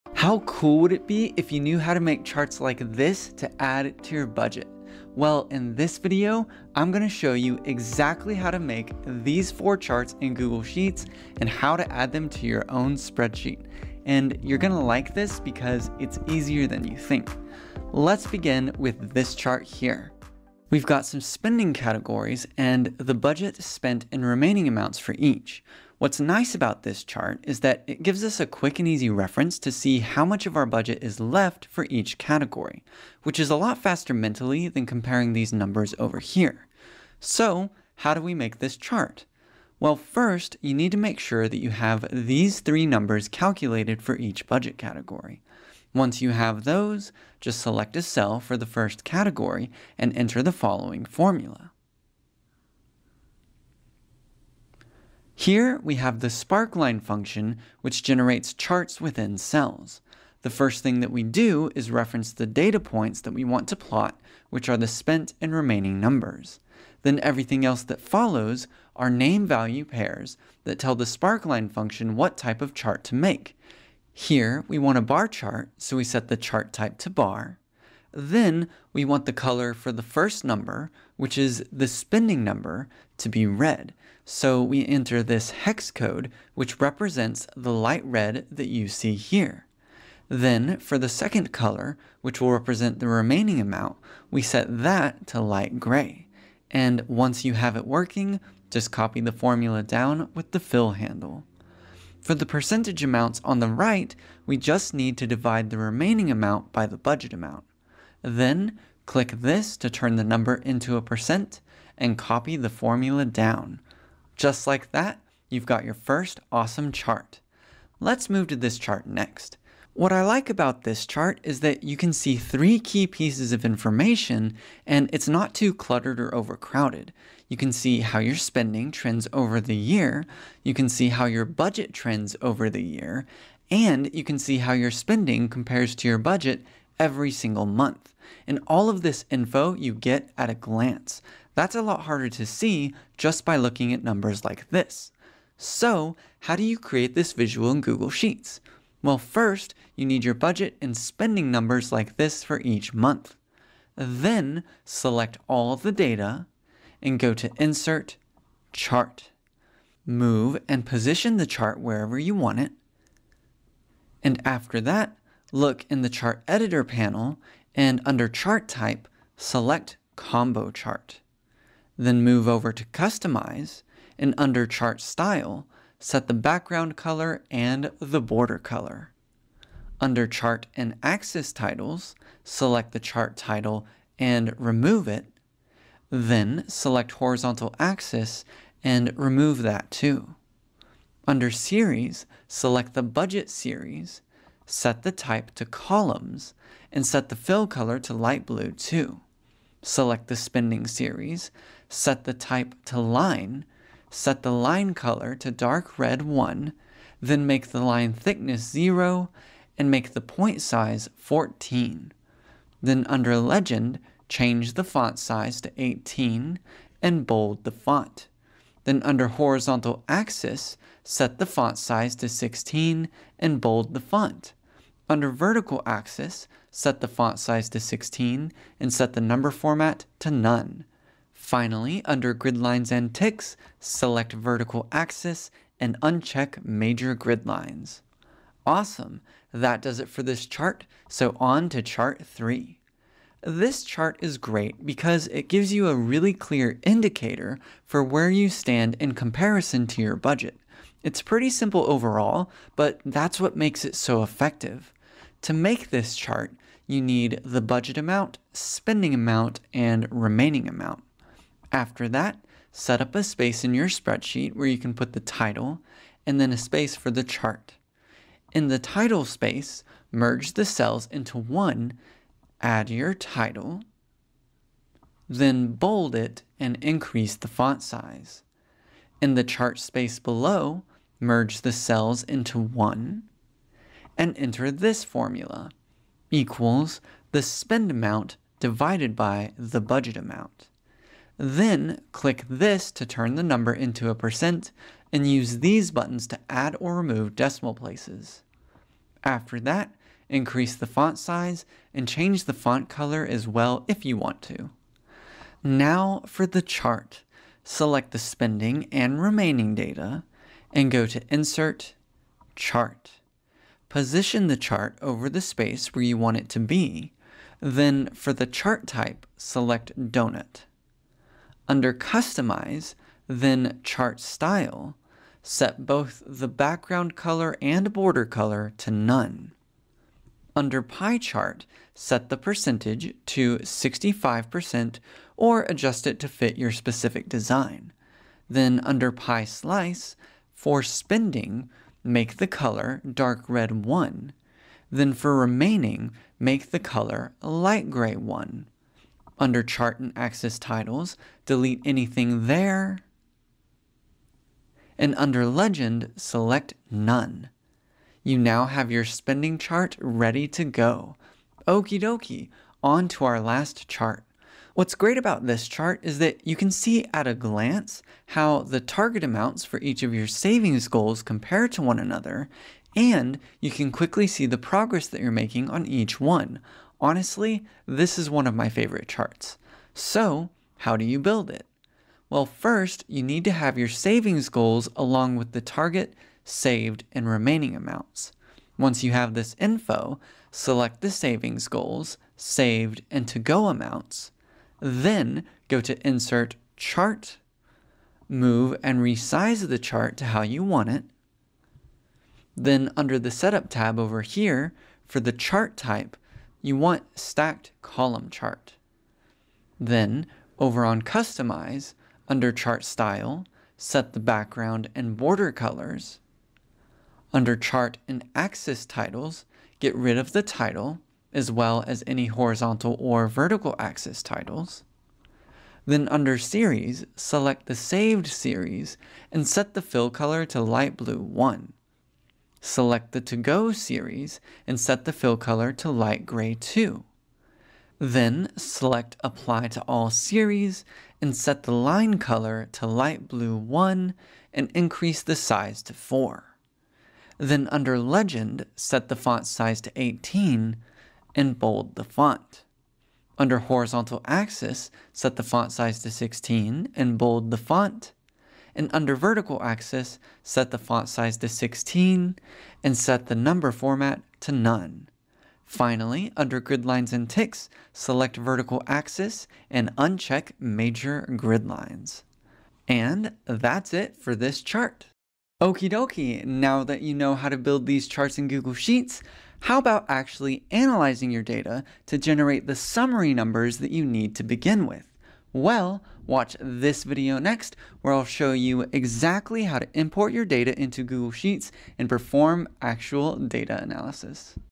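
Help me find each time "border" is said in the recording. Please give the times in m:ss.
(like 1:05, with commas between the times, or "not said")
2:58, 5:27, 6:55.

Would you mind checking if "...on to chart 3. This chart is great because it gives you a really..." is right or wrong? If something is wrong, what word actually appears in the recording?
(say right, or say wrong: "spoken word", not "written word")
right.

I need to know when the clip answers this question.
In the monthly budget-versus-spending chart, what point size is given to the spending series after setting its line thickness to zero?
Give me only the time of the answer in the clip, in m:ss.
3:31.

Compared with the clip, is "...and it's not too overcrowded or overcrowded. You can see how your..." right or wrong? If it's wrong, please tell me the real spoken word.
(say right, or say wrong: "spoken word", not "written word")
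wrong: "cluttered", not "overcrowded".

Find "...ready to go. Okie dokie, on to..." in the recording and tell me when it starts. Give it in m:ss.
5:59.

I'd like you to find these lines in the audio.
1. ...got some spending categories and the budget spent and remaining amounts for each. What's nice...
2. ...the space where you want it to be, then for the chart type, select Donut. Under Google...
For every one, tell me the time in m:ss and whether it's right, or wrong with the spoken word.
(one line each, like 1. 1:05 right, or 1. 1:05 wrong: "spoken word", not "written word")
1. 0:20 right
2. 5:15 wrong: "Customize", not "Google".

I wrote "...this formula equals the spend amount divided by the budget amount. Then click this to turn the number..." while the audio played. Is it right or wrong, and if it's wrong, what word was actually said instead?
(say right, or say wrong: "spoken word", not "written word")
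right.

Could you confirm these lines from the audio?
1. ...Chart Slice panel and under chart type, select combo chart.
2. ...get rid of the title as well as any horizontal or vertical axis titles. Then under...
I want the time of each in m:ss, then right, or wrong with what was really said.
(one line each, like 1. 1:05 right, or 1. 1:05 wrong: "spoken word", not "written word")
1. 2:46 wrong: "Editor", not "Slice"
2. 6:59 right.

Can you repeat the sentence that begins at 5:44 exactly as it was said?
Then for remaining, make the color light gray 1.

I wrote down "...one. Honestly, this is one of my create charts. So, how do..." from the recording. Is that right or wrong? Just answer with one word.
wrong.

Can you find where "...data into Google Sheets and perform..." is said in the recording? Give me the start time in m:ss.
8:10.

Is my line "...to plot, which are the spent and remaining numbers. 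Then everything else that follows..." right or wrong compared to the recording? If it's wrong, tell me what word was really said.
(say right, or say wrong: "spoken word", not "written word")
right.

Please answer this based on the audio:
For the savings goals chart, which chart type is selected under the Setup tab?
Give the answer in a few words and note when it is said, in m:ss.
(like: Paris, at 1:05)
Stacked Column Chart, at 6:47.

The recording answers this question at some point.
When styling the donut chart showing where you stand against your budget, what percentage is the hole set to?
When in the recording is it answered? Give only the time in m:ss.
5:33.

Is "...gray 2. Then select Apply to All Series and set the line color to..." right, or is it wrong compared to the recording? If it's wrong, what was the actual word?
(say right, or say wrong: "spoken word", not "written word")
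right.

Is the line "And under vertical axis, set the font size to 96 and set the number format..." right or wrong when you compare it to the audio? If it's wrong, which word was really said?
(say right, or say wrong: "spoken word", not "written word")
wrong: "16", not "96".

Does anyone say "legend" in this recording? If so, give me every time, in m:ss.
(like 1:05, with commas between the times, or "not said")
3:33, 5:55, 7:27.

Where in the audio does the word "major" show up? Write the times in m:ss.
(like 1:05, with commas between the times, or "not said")
3:56, 7:50.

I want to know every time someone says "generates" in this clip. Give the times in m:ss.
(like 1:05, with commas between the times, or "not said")
0:58, 8:02.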